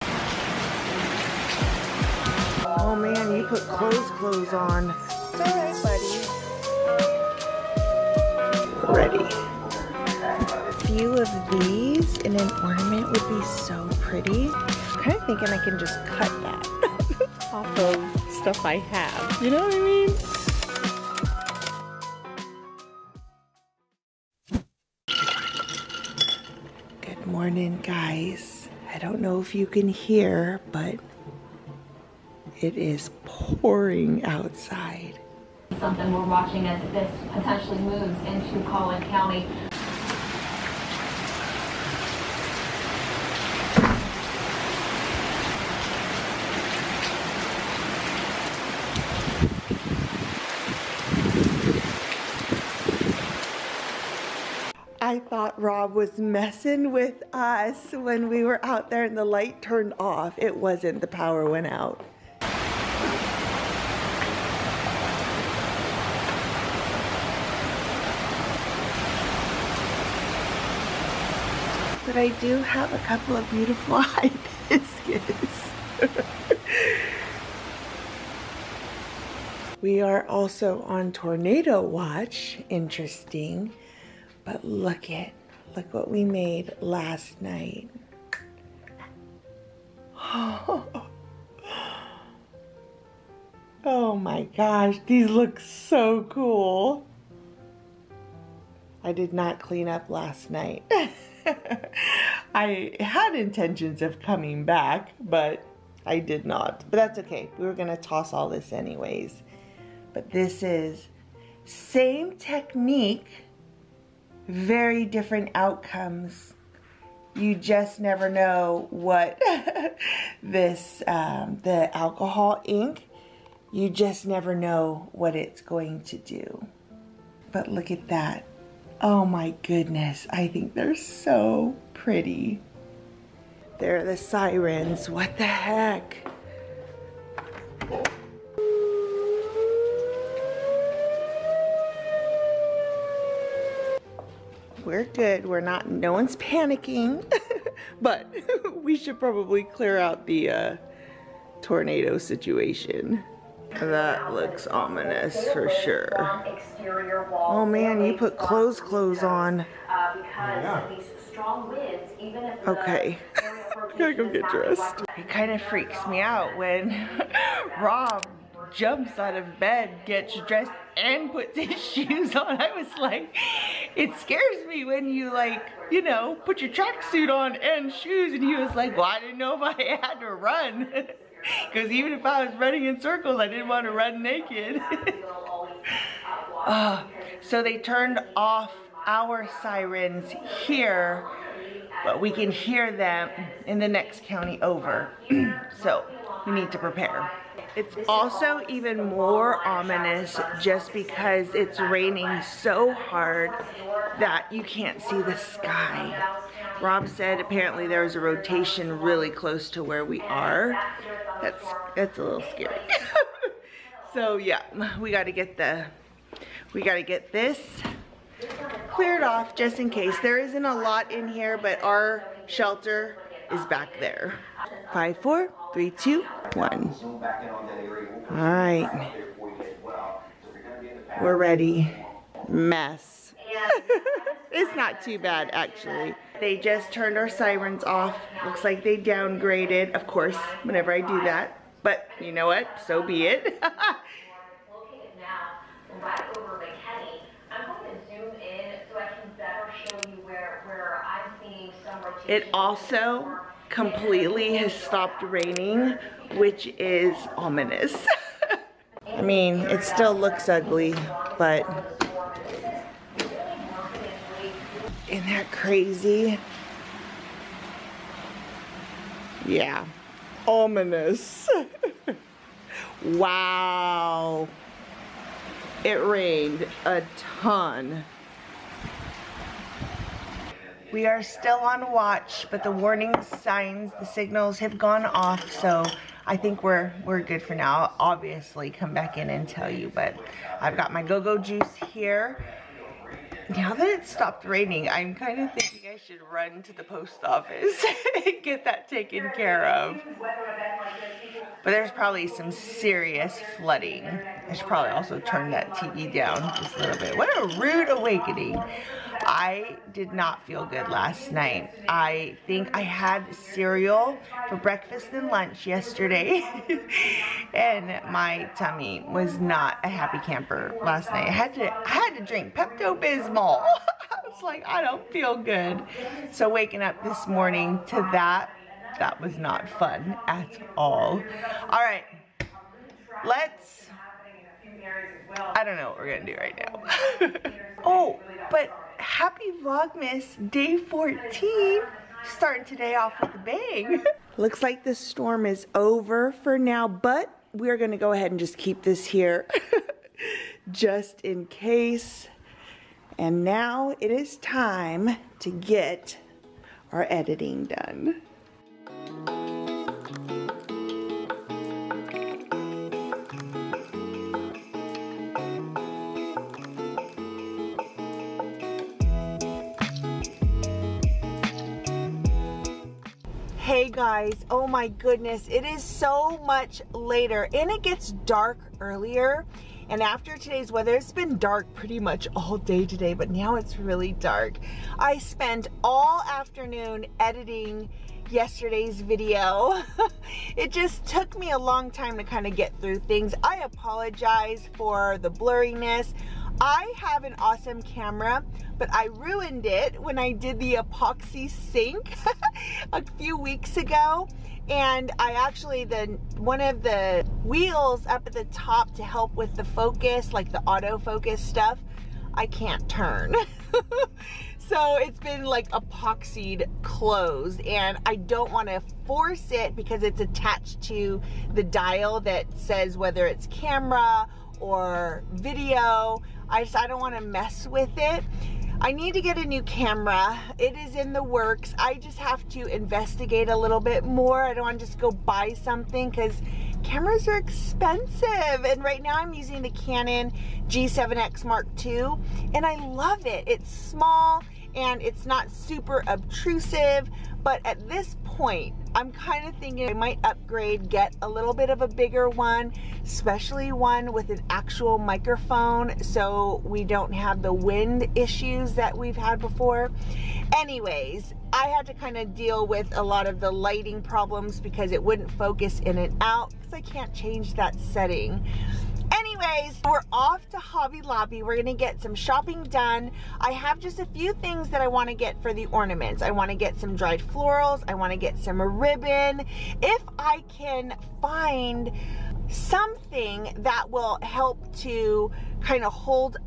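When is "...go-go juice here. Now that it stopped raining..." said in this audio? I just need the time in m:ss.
4:51.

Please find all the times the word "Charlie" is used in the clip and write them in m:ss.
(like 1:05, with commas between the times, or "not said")
not said.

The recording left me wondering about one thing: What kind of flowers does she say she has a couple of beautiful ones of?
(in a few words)
hibiscus.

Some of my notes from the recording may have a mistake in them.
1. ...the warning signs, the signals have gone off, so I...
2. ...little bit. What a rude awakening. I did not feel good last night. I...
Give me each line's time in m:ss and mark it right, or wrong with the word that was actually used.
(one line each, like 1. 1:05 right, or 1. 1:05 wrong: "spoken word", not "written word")
1. 4:42 right
2. 5:06 right.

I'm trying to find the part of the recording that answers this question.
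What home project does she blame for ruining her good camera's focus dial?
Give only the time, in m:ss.
6:40.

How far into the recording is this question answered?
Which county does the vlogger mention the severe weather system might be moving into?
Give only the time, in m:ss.
0:38.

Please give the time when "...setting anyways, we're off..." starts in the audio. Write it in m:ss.
7:47.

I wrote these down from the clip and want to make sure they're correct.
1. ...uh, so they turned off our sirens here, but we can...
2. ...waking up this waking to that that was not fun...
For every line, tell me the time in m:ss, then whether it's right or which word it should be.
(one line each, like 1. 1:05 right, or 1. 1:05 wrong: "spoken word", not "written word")
1. 3:06 right
2. 5:26 wrong: "morning", not "waking".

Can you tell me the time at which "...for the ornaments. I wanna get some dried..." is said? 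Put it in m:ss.
7:55.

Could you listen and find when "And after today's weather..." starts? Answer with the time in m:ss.
6:19.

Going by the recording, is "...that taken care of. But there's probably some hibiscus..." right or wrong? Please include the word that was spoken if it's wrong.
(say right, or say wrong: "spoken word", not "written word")
wrong: "serious", not "hibiscus".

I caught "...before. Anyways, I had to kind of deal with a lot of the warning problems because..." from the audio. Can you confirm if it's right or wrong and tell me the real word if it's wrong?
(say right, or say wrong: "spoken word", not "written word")
wrong: "lighting", not "warning".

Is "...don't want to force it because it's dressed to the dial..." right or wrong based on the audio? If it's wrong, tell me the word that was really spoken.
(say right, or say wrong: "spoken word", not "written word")
wrong: "attached", not "dressed".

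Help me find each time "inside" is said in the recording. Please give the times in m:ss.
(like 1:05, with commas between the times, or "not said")
not said.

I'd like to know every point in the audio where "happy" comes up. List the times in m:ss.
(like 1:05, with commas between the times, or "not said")
5:19, 5:38.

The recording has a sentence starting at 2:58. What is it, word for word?
And he was like, well, I didn't know if I had to run.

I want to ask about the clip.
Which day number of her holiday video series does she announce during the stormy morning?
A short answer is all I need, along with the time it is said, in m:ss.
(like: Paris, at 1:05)
14, at 5:40.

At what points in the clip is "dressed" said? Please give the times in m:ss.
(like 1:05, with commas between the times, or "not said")
2:44, 2:50.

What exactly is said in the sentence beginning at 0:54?
I thought Rob was messing with us when we were out there and the light turned off.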